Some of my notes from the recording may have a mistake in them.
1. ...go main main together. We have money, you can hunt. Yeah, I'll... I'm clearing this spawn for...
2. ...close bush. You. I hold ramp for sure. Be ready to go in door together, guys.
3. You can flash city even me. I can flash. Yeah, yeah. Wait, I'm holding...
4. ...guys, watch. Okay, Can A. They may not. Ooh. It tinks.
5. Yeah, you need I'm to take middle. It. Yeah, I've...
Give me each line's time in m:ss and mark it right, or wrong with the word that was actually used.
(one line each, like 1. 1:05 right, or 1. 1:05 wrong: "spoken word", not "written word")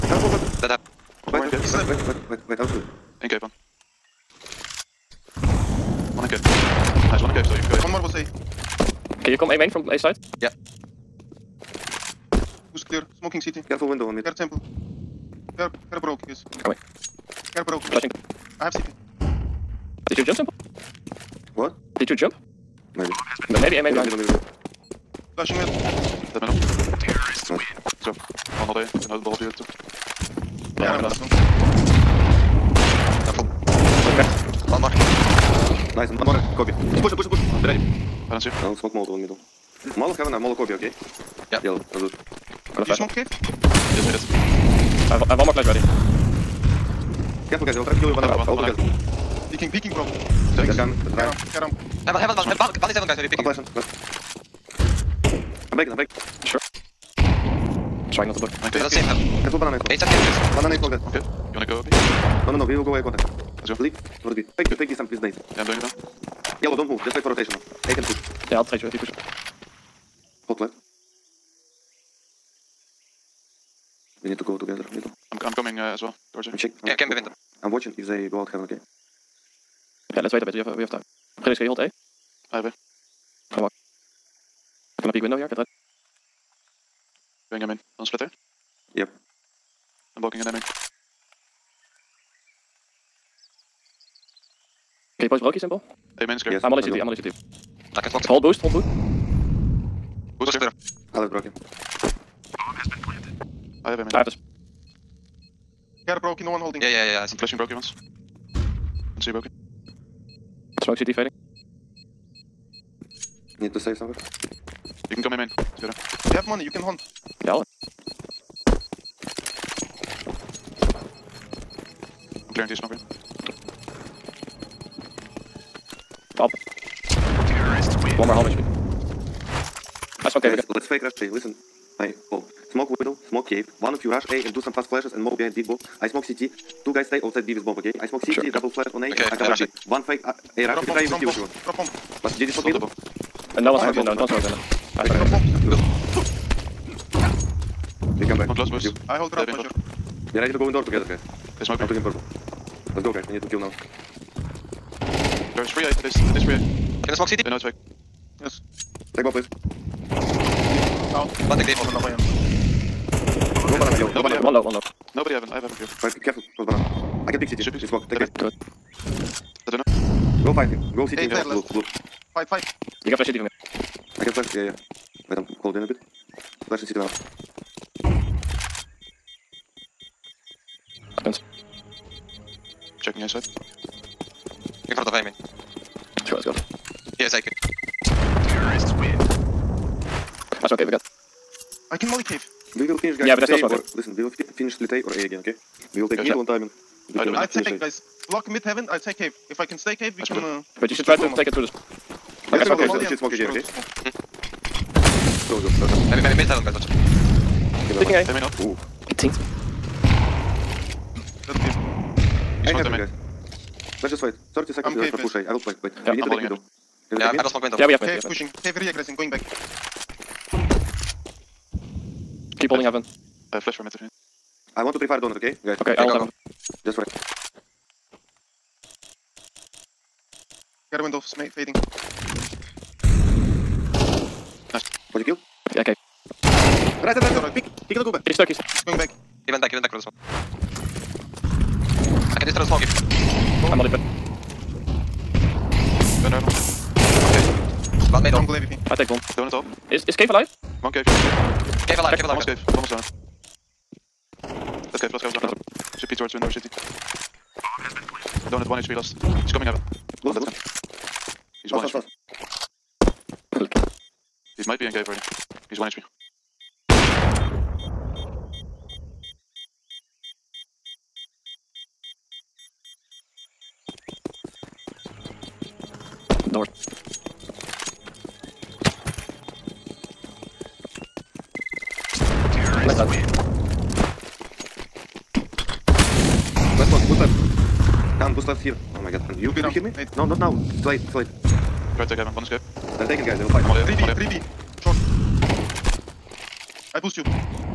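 1. 1:55 right
2. 2:28 right
3. 2:53 right
4. 3:26 wrong: "Taking", not "Can"
5. 3:36 right.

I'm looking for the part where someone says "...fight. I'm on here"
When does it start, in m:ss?
4:53.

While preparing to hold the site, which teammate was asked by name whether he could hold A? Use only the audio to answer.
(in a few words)
Felix.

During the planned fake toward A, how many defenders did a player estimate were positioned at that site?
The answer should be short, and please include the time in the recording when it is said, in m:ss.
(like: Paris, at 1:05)
at least 3, at 2:36.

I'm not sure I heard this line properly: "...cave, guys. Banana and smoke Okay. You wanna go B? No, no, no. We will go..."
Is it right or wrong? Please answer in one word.
right.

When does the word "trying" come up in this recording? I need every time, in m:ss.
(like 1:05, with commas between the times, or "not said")
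0:51, 0:58.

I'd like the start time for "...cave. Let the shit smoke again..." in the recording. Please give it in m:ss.
3:22.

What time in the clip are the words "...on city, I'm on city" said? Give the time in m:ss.
1:36.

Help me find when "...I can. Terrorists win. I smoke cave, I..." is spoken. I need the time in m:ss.
3:07.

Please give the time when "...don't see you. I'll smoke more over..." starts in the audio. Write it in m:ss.
0:38.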